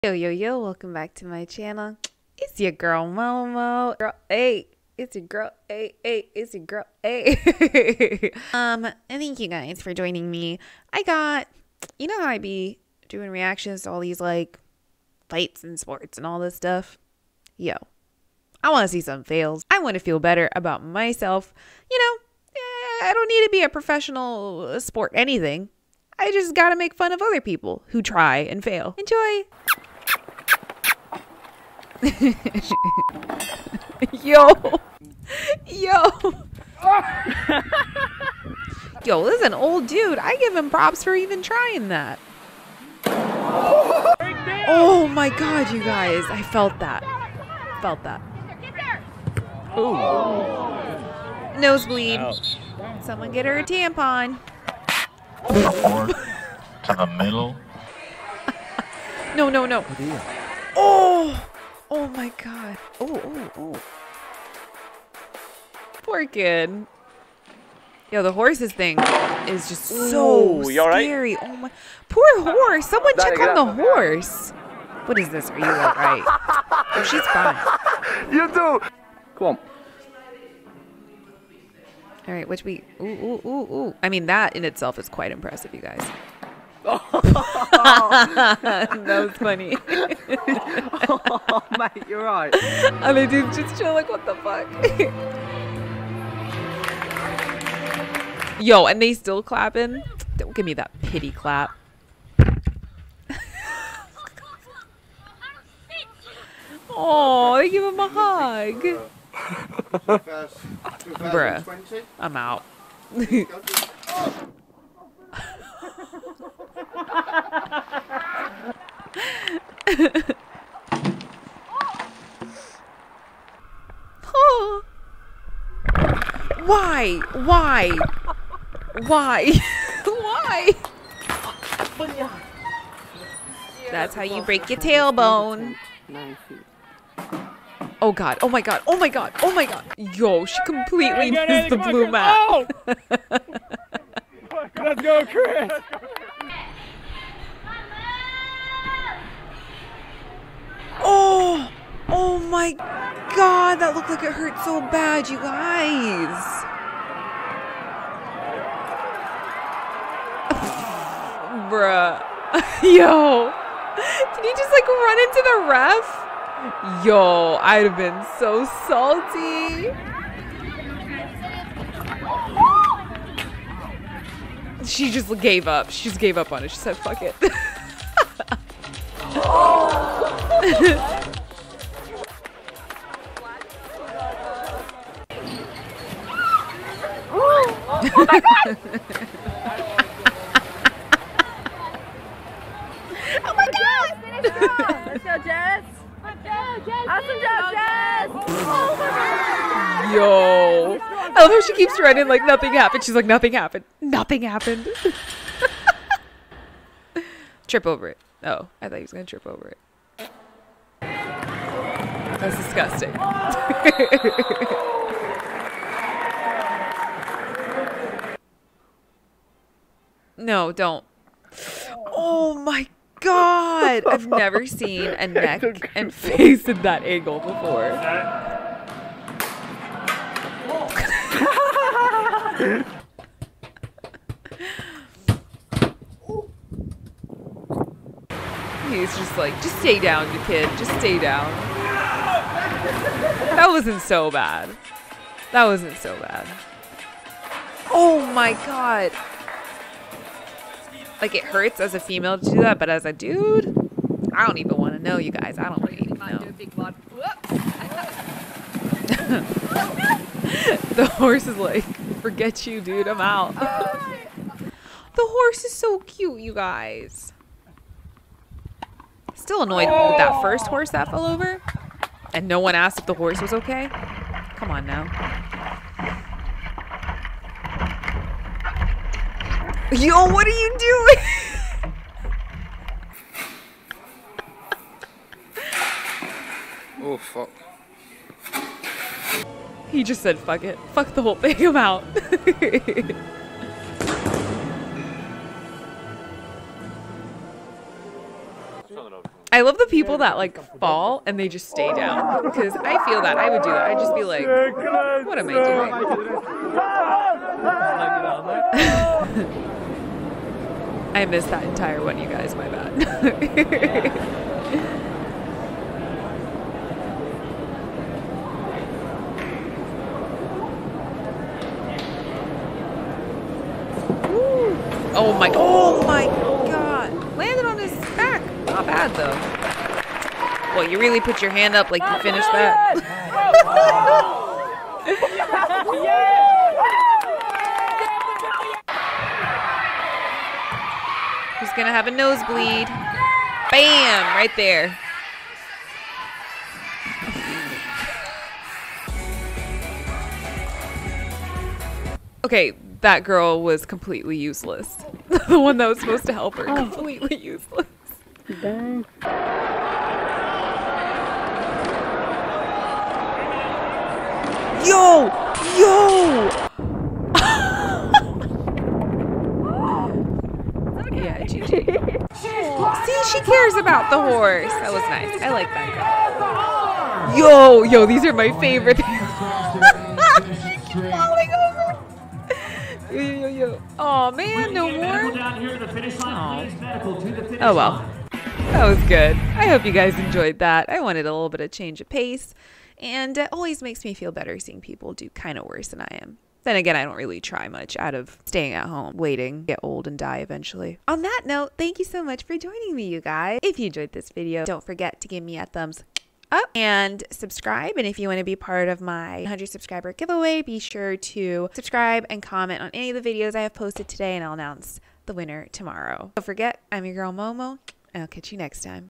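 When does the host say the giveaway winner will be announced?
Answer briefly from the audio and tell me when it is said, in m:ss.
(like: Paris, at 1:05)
tomorrow, at 6:54.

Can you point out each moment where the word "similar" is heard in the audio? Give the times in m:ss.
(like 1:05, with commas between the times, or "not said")
not said.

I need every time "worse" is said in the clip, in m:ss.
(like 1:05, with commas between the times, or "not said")
6:35.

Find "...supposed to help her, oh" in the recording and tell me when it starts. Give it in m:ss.
5:55.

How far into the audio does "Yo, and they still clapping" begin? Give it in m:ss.
1:38.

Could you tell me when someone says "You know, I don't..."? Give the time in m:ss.
0:21.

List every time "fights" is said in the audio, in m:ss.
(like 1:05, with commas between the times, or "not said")
0:15.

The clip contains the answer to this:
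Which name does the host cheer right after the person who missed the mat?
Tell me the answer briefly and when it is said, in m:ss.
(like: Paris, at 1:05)
Chris, at 2:24.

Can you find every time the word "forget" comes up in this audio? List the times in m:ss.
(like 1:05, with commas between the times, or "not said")
4:22, 6:44, 6:56.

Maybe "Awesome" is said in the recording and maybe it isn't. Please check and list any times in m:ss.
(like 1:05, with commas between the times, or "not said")
3:17.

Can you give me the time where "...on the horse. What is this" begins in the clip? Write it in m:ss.
1:13.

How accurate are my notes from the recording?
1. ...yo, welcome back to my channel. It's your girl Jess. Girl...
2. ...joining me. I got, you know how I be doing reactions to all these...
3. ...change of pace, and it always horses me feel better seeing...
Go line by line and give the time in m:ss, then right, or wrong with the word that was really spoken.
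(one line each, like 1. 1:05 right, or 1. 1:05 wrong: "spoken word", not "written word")
1. 0:00 wrong: "Momo", not "Jess"
2. 0:09 right
3. 6:31 wrong: "makes", not "horses".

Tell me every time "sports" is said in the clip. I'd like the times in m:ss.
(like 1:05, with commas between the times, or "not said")
0:15, 0:24.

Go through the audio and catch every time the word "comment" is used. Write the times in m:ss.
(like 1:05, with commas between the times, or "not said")
6:52.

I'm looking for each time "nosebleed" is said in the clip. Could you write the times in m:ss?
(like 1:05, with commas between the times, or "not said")
0:51, 5:42.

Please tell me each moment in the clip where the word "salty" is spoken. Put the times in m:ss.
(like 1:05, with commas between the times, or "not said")
2:48.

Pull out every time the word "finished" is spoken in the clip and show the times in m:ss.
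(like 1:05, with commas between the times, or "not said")
5:32.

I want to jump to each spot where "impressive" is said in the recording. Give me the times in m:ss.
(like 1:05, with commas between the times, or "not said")
1:25.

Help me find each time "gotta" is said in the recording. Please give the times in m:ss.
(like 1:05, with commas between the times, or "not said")
0:26.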